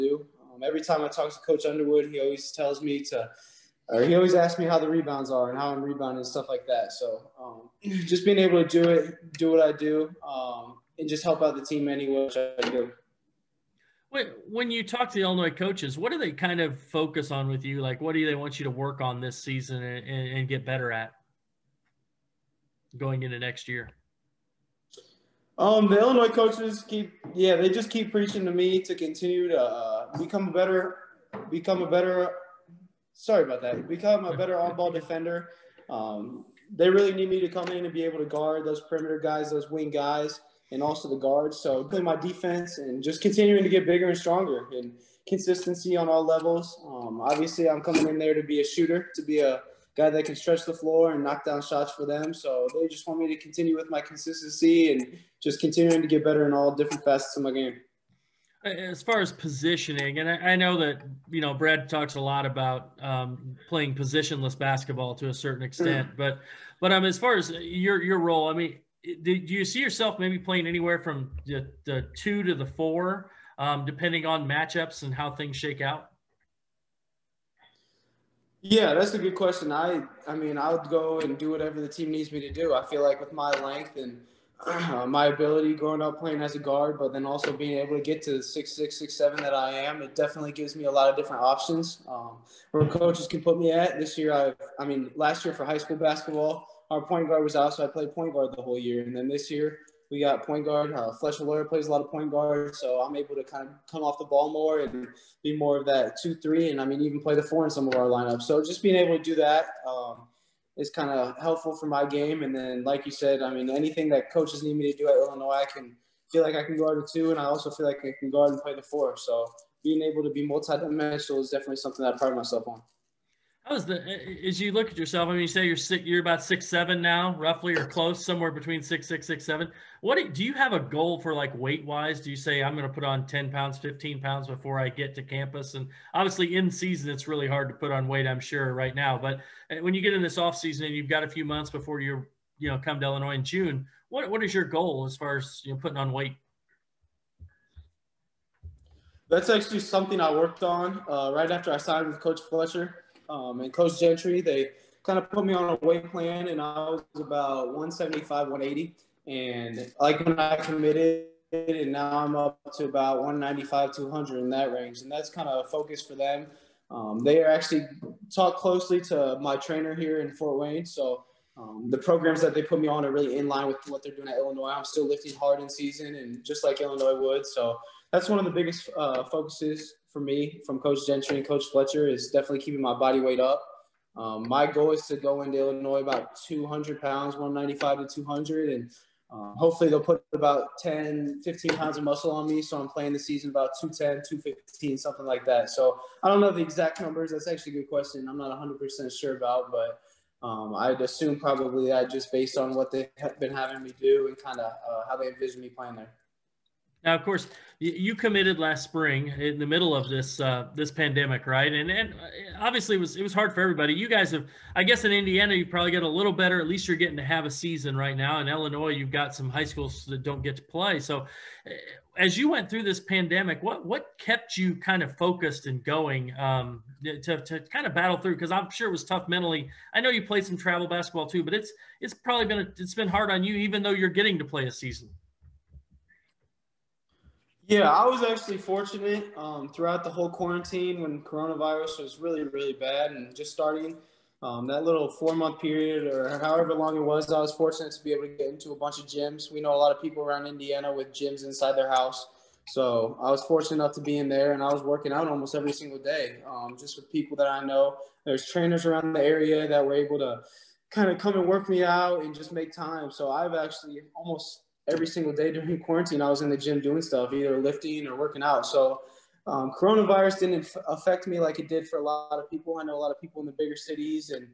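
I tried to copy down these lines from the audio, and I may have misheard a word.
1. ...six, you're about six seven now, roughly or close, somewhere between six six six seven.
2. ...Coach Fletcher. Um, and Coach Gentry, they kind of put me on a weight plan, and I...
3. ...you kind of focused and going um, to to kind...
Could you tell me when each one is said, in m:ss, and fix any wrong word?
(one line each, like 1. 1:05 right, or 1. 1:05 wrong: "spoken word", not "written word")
1. 2:05 right
2. 2:32 right
3. 3:44 right.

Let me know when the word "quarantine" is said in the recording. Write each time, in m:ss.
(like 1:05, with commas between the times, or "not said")
4:00, 4:25.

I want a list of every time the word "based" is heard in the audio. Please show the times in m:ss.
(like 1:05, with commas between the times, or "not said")
3:22.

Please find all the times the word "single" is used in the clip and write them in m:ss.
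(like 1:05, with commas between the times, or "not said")
4:15, 4:25.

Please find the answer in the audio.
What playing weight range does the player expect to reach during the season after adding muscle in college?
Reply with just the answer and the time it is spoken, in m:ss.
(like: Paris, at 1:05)
210-215, at 3:13.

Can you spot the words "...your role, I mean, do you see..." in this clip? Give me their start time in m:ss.
1:08.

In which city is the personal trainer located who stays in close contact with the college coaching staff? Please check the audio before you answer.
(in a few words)
Fort Wayne.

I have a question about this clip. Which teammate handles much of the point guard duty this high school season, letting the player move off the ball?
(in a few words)
Fletcher Lawyer.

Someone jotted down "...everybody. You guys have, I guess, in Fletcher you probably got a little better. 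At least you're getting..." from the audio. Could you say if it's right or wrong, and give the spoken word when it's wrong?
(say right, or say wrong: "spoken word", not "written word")
wrong: "Indiana", not "Fletcher".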